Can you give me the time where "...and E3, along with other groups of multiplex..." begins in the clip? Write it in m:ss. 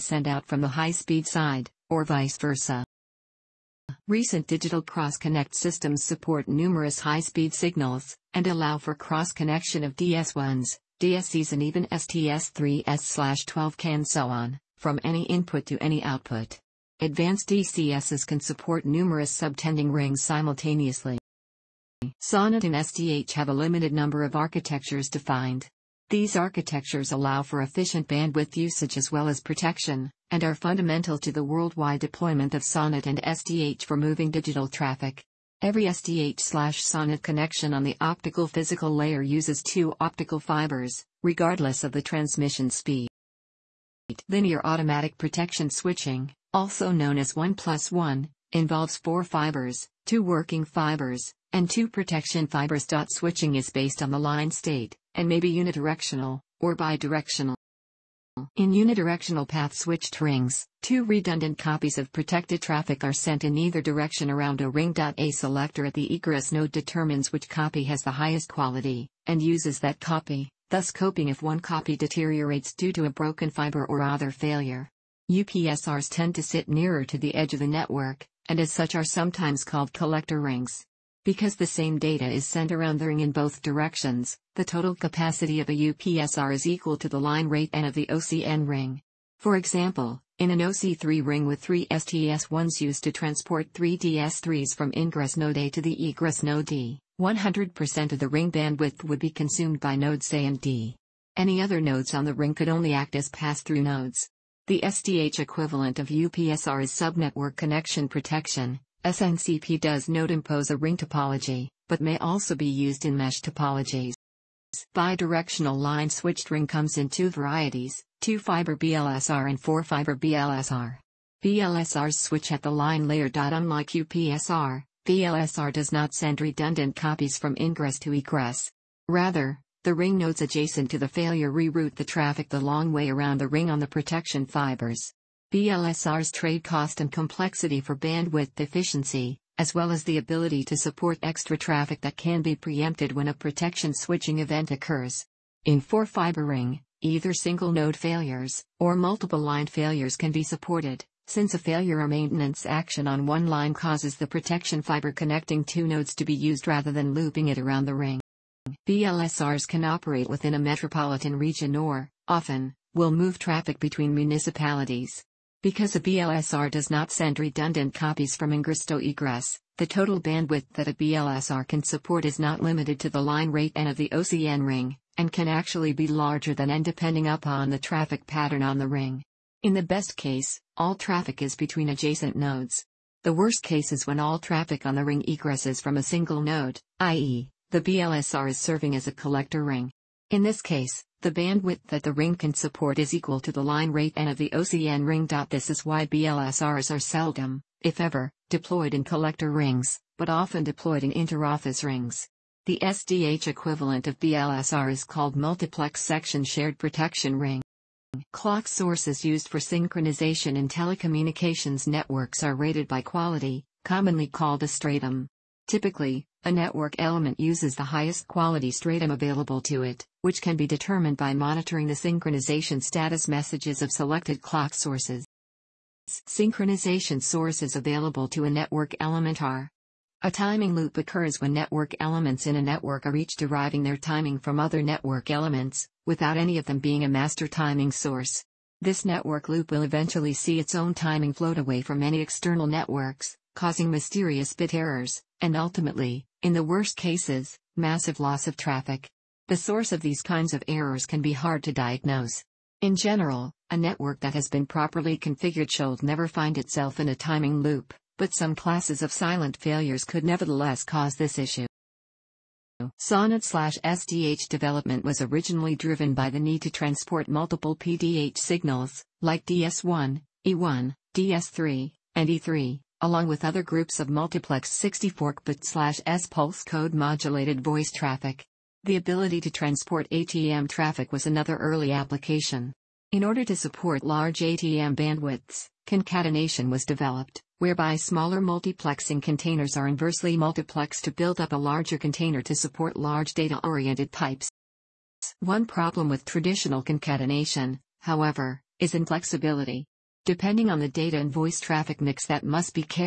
4:32.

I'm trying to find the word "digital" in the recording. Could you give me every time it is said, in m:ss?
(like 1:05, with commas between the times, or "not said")
0:04, 0:34.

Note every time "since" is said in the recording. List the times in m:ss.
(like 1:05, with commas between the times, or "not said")
2:31.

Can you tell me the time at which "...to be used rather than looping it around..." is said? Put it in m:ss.
2:36.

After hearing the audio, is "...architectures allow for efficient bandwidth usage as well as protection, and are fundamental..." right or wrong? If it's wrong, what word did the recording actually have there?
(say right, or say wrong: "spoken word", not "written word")
right.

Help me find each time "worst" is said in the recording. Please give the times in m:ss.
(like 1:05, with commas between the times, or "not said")
3:03, 4:06.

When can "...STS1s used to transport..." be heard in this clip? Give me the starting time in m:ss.
1:31.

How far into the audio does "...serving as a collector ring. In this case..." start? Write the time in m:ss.
3:08.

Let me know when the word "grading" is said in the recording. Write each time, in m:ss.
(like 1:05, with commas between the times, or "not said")
not said.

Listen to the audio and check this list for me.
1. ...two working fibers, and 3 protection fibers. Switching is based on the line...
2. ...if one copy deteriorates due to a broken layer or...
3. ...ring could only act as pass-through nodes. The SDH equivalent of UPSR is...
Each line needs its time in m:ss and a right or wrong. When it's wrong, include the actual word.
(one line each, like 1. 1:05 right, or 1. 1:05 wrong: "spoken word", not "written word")
1. 0:50 wrong: "2", not "3"
2. 1:11 wrong: "fiber", not "layer"
3. 1:42 right.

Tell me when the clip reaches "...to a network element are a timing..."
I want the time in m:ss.
3:48.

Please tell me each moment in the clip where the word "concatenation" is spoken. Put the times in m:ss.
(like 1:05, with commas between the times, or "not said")
4:45, 4:56.